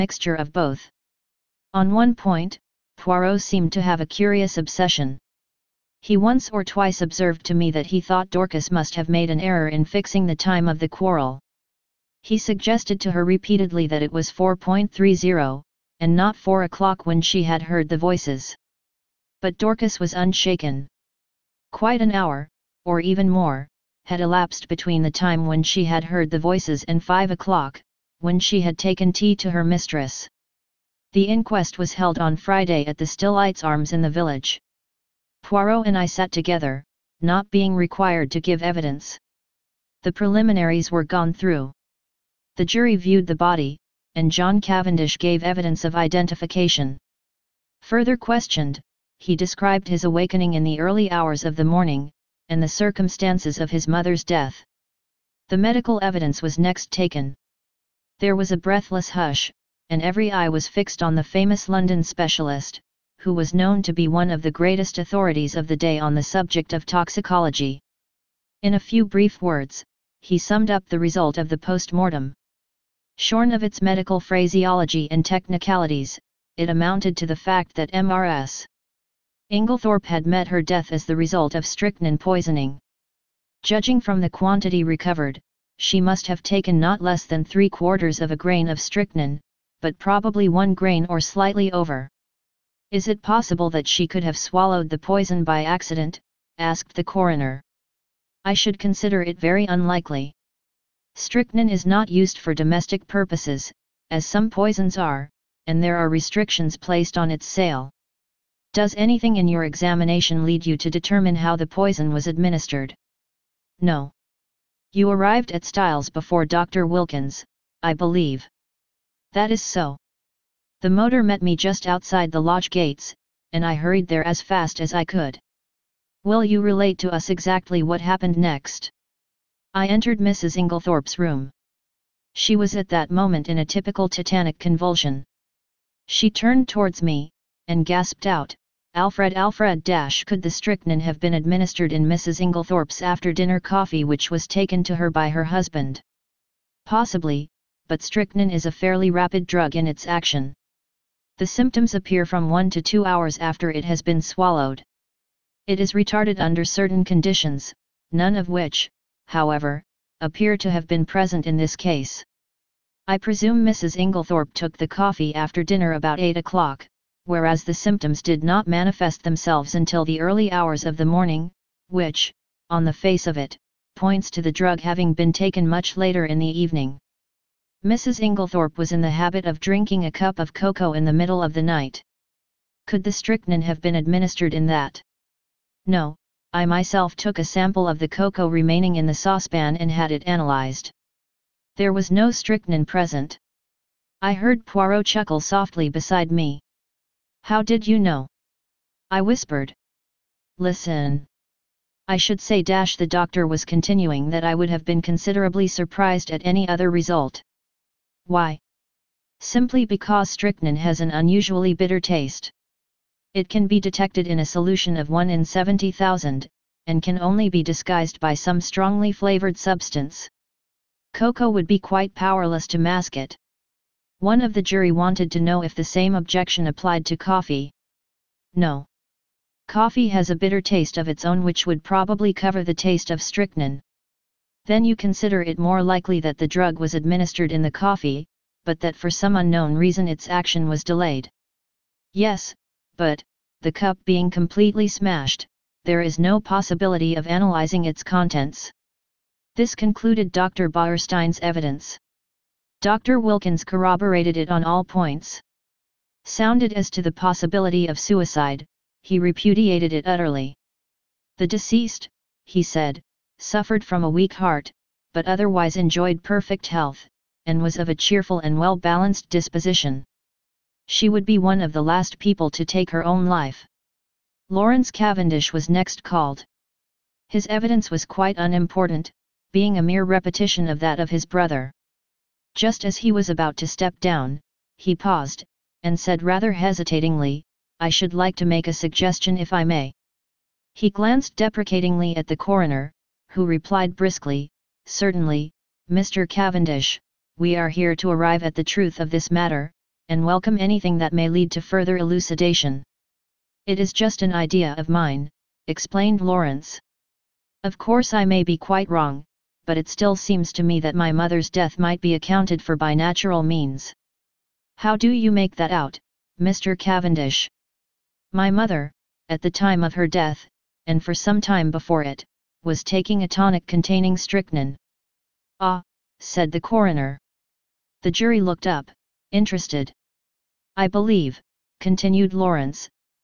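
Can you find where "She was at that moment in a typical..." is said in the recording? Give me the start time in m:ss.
2:12.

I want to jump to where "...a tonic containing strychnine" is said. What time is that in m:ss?
5:23.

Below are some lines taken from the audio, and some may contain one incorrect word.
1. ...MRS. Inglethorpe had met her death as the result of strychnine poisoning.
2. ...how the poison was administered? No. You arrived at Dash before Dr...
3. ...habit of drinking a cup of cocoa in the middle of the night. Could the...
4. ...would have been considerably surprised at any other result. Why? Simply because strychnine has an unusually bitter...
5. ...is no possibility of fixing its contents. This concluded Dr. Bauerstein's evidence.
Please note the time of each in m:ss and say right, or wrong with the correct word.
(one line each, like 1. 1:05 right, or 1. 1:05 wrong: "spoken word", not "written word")
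1. 1:17 right
2. 1:51 wrong: "Styles", not "Dash"
3. 2:59 right
4. 3:24 right
5. 4:06 wrong: "analyzing", not "fixing".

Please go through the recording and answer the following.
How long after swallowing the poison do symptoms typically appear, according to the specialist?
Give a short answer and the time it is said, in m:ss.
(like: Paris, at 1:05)
1 to 2 hours, at 2:32.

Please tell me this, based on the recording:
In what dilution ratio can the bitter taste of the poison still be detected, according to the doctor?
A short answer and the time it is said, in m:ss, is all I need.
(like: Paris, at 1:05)
1 in 70,000, at 3:35.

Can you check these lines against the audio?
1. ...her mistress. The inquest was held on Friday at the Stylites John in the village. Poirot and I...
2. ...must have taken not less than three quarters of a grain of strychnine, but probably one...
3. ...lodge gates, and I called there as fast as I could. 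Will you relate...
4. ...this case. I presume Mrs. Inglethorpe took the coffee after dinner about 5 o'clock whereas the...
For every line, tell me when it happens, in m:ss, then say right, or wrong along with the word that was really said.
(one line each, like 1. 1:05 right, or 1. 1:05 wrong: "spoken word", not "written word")
1. 0:29 wrong: "Arms", not "John"
2. 1:25 right
3. 2:02 wrong: "hurried", not "called"
4. 2:41 wrong: "8", not "5".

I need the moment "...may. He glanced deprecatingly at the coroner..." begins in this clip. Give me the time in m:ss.
4:49.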